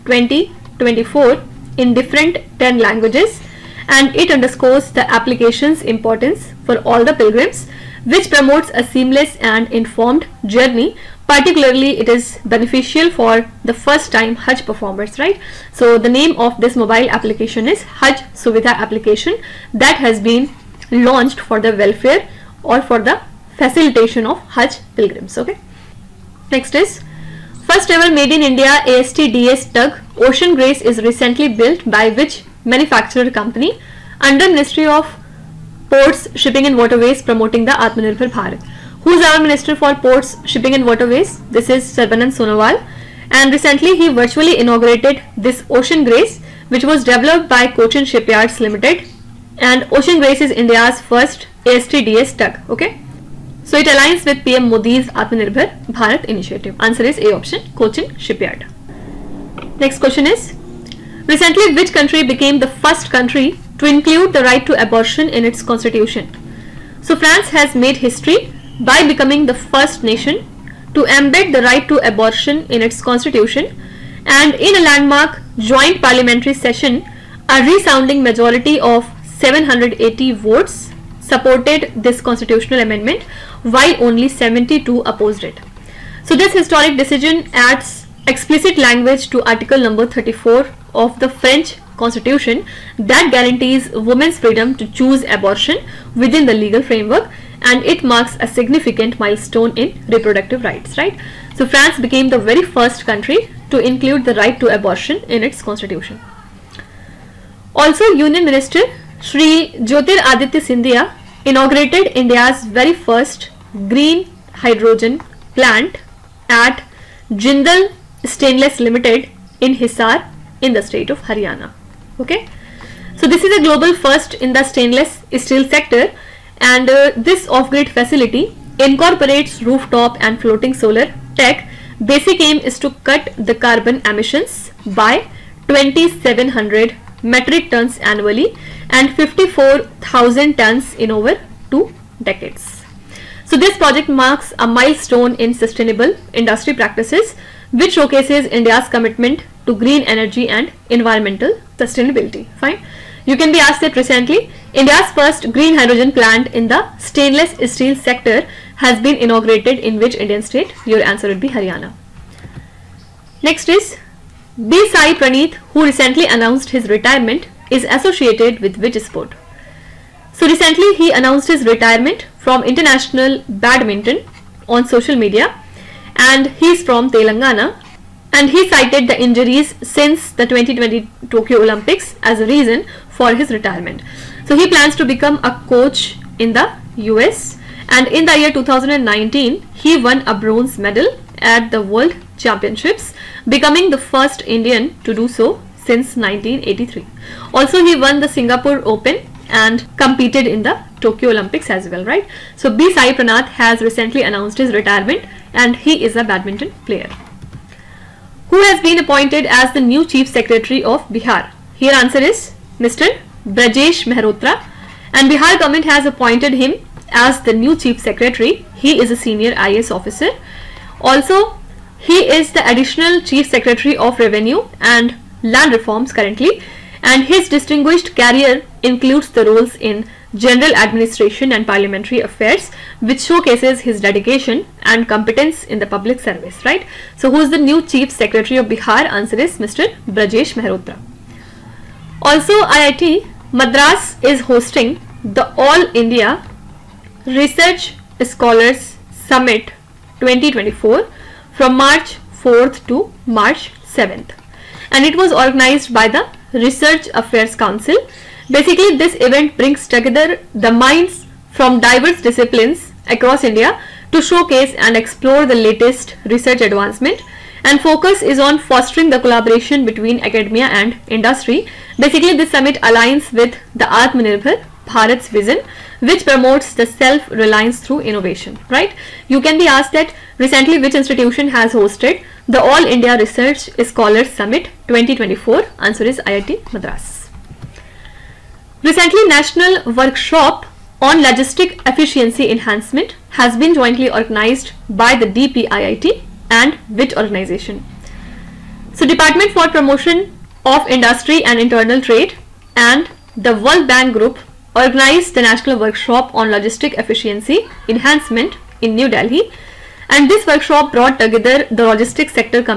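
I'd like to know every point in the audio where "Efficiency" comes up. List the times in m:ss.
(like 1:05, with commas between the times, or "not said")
4:51, 5:06.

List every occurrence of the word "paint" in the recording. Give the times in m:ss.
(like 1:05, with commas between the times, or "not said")
not said.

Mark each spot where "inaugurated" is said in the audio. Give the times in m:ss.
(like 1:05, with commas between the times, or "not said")
0:44, 1:51, 2:39.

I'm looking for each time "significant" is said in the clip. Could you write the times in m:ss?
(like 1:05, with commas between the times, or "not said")
1:38.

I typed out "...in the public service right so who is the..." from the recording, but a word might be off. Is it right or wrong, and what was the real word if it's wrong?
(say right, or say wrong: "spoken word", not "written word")
right.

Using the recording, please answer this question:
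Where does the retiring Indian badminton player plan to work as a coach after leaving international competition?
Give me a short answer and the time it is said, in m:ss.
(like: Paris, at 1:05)
the US, at 3:06.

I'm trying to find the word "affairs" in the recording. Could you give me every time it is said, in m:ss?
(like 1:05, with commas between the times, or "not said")
3:52, 4:17.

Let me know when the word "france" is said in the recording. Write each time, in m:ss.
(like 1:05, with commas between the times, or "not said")
1:07, 1:41.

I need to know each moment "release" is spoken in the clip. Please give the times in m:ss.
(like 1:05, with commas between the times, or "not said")
not said.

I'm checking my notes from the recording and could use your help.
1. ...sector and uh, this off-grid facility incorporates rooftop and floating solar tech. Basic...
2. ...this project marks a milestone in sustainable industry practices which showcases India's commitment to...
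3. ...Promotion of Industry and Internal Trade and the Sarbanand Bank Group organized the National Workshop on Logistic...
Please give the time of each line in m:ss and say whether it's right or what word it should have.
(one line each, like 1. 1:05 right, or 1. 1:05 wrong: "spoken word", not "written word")
1. 2:05 right
2. 2:23 right
3. 4:59 wrong: "World", not "Sarbanand".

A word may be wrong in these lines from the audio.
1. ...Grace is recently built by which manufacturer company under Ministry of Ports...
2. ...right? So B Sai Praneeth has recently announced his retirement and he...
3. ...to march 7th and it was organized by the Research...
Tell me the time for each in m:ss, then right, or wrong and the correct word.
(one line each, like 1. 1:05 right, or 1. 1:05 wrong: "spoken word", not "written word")
1. 0:30 right
2. 3:22 right
3. 4:12 right.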